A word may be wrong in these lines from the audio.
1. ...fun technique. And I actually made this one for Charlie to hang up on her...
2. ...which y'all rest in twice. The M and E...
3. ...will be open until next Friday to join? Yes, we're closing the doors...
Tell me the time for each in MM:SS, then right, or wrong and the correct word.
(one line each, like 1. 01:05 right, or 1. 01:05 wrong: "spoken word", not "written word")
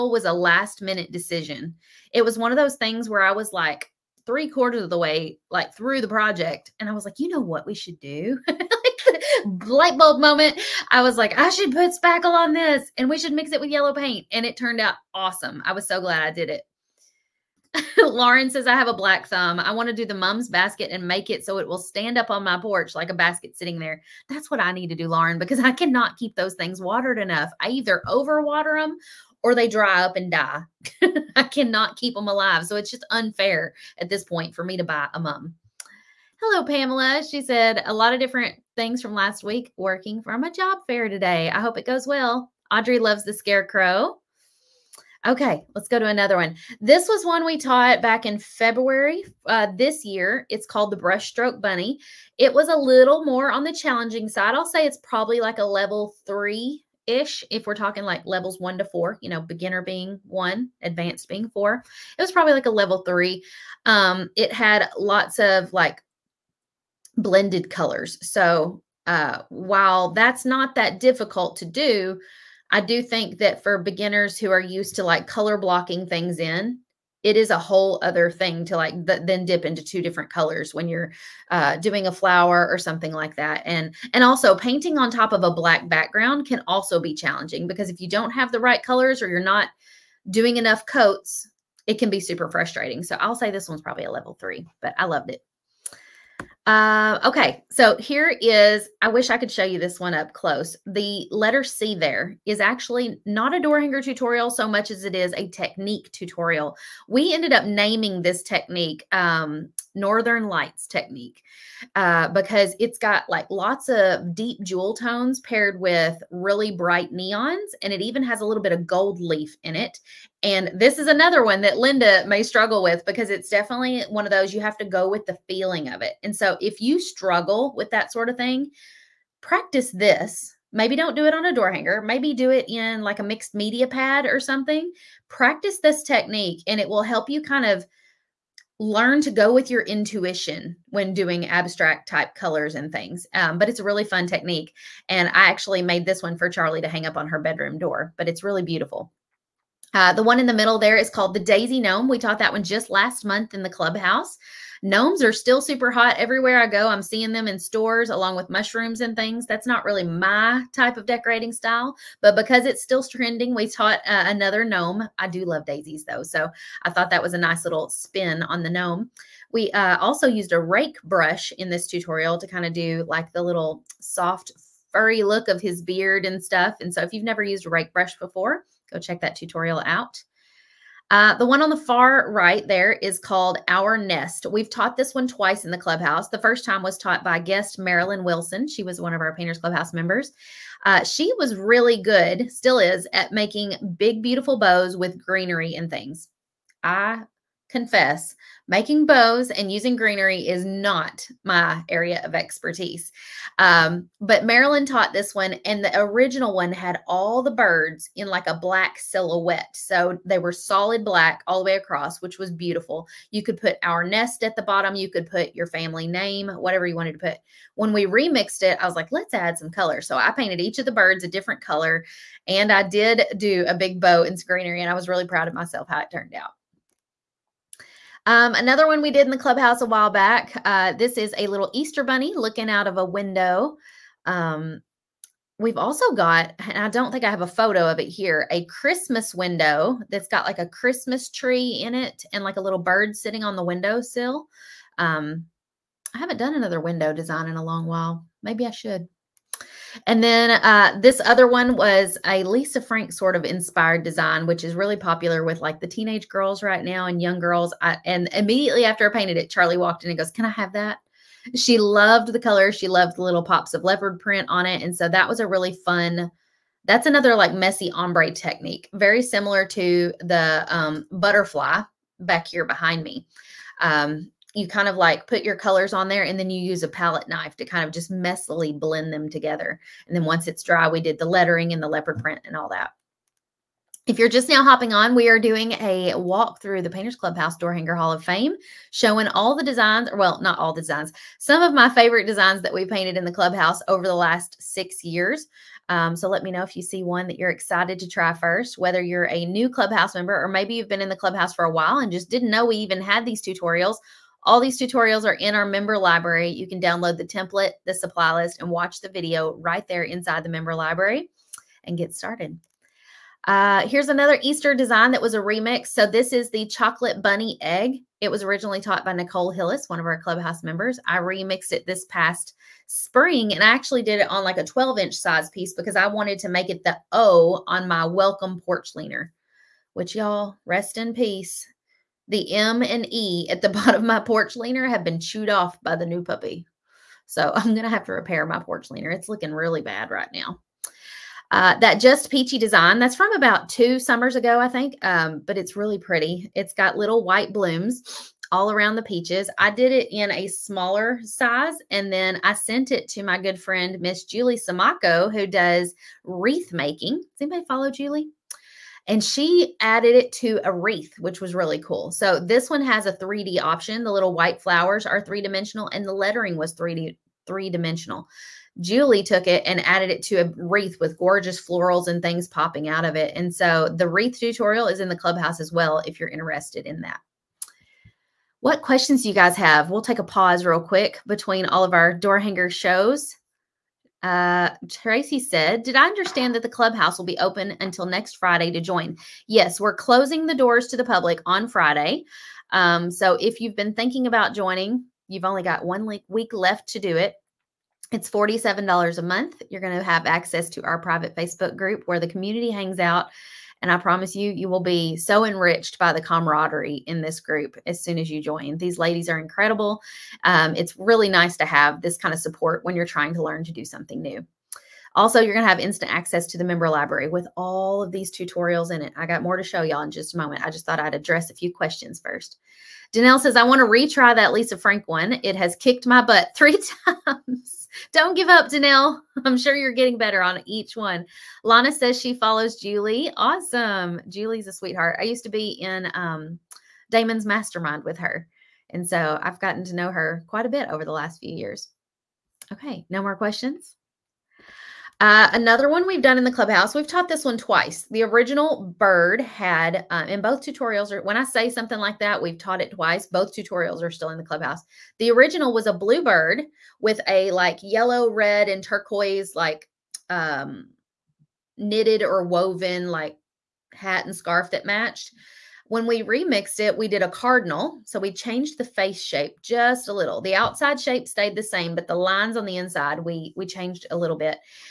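1. 02:24 right
2. 05:29 wrong: "peace", not "twice"
3. 06:27 right.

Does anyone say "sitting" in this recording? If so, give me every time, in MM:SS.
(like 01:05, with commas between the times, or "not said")
00:23, 04:03.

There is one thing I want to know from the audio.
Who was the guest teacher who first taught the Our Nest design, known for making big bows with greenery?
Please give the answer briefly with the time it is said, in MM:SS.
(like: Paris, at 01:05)
Marilyn Wilson, at 03:07.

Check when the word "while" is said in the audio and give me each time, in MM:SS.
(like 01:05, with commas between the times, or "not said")
01:09, 03:49, 04:07, 05:01.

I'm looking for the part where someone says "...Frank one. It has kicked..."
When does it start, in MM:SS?
07:04.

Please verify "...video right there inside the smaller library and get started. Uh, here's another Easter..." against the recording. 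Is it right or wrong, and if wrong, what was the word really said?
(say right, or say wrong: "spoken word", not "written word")
wrong: "member", not "smaller".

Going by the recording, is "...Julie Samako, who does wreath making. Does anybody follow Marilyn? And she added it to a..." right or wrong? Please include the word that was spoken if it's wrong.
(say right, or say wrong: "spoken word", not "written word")
wrong: "Julie", not "Marilyn".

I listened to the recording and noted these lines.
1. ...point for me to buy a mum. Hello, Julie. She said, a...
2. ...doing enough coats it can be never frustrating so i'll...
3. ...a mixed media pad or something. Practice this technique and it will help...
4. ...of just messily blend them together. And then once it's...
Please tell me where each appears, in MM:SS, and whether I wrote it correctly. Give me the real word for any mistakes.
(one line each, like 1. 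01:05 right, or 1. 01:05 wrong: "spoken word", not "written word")
1. 00:34 wrong: "Pamela", not "Julie"
2. 01:30 wrong: "super", not "never"
3. 02:13 right
4. 04:37 right.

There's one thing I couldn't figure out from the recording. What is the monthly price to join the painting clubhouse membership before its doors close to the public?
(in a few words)
$47.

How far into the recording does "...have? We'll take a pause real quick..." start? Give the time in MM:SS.
06:19.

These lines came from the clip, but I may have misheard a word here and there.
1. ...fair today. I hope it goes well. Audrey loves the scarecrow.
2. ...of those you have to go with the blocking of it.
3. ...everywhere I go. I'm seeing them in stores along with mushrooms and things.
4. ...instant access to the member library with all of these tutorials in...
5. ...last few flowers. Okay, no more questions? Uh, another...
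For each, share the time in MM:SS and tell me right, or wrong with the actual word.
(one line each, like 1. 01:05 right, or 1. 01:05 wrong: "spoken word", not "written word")
1. 00:40 right
2. 02:04 wrong: "feeling", not "blocking"
3. 02:36 right
4. 06:55 right
5. 07:21 wrong: "years", not "flowers".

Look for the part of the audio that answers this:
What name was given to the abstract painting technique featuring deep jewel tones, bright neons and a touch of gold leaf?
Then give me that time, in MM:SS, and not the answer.
01:49.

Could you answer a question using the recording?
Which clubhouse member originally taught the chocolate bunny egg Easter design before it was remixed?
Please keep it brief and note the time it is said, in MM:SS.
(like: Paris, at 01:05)
Nicole Hillis, at 05:19.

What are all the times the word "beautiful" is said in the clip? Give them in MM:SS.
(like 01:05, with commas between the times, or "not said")
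02:28, 03:14, 03:32.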